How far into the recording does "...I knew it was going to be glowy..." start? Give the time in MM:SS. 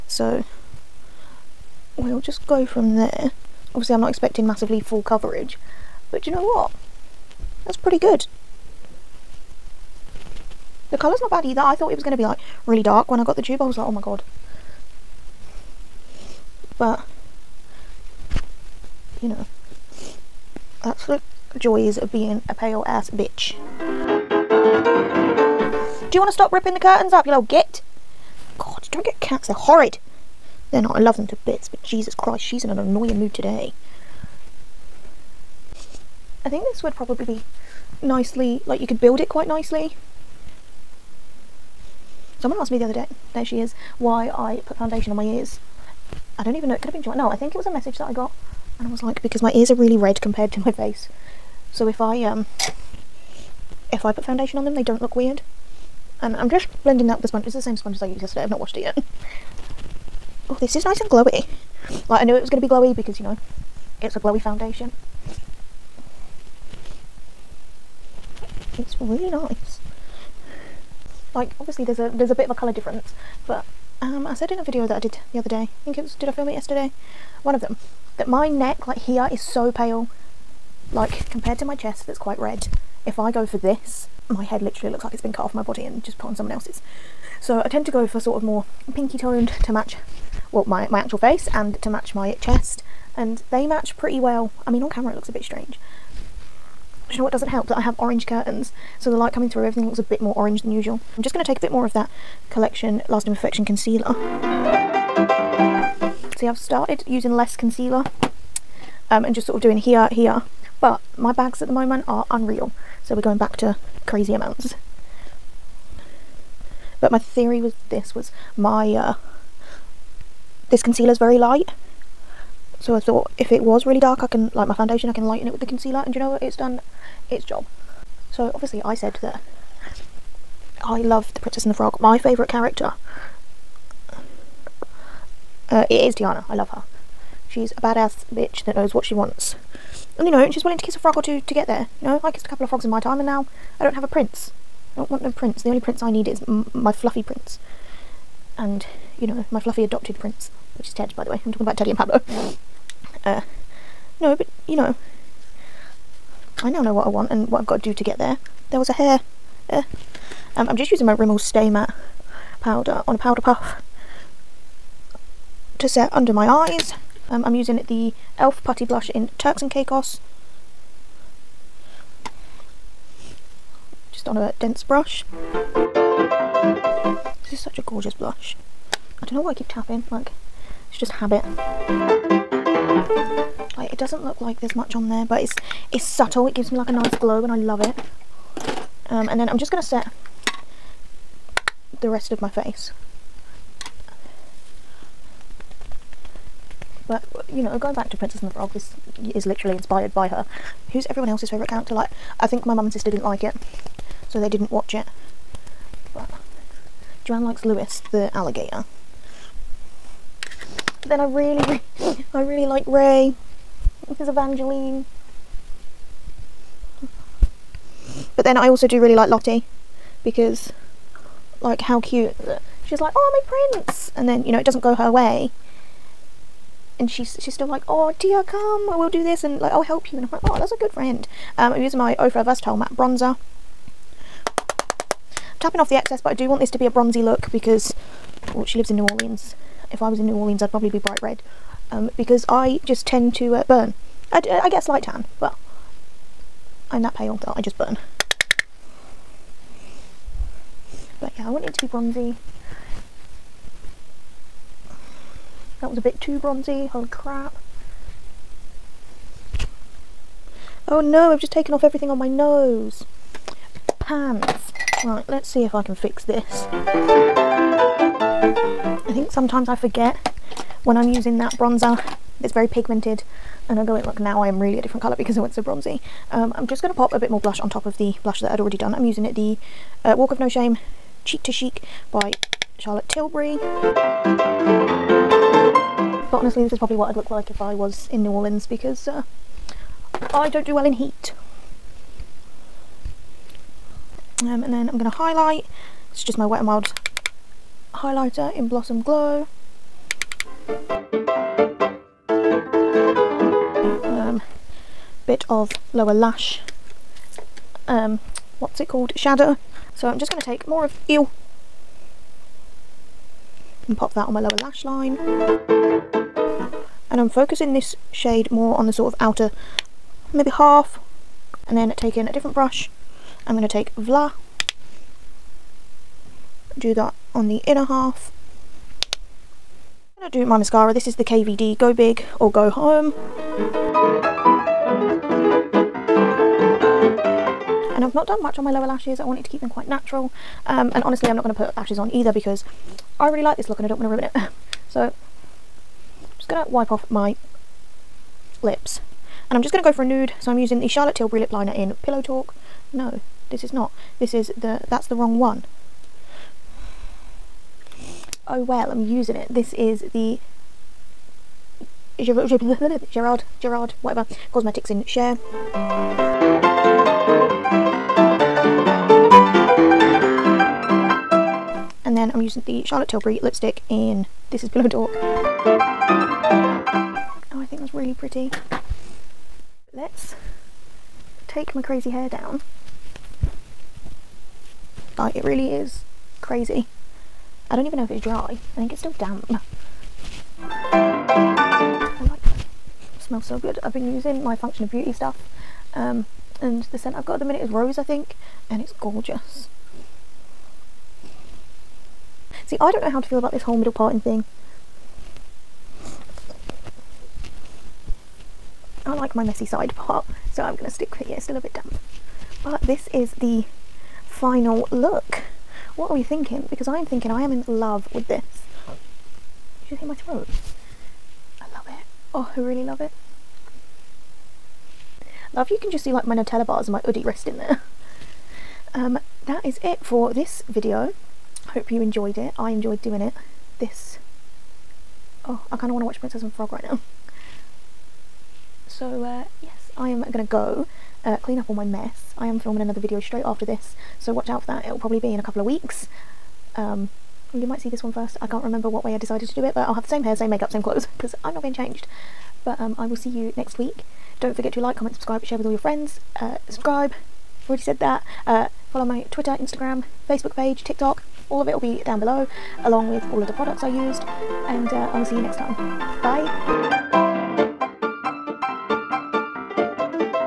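01:02.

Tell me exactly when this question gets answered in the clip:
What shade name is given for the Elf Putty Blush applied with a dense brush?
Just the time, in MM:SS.
02:49.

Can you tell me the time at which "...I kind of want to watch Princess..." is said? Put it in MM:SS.
07:15.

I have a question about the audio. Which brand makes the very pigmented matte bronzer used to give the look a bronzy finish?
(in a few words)
Ofra.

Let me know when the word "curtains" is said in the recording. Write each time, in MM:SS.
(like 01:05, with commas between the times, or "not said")
00:26, 01:38.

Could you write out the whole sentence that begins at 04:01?
Um, because I just tend to uh, burn.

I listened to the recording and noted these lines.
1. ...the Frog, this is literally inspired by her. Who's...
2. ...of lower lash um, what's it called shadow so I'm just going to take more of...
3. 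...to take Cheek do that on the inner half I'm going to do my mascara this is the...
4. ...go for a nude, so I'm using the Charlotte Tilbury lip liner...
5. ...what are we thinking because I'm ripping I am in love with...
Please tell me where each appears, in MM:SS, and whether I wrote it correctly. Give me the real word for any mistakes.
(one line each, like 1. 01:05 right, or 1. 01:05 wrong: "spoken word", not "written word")
1. 03:18 right
2. 05:05 right
3. 05:23 wrong: "Vla", not "Cheek"
4. 05:49 right
5. 06:55 wrong: "thinking", not "ripping".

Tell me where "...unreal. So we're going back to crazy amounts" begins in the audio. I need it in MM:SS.
01:52.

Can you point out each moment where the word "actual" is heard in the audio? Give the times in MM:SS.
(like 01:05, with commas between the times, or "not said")
01:30.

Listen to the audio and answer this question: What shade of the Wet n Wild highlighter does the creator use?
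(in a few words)
Blossom Glow.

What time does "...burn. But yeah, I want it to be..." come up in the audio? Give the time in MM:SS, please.
04:07.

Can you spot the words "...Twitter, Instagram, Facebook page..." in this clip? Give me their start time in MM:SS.
07:39.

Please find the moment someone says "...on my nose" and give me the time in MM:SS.
04:22.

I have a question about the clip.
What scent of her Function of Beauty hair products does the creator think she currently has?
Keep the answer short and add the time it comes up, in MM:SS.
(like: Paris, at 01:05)
Rose, at 06:37.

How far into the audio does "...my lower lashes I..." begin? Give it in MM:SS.
05:38.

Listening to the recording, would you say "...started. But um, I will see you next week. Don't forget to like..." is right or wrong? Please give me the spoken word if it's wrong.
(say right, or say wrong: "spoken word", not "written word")
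wrong: "changed", not "started".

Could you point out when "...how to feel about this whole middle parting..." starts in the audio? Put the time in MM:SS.
06:43.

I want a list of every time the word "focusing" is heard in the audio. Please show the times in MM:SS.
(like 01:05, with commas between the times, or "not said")
05:17.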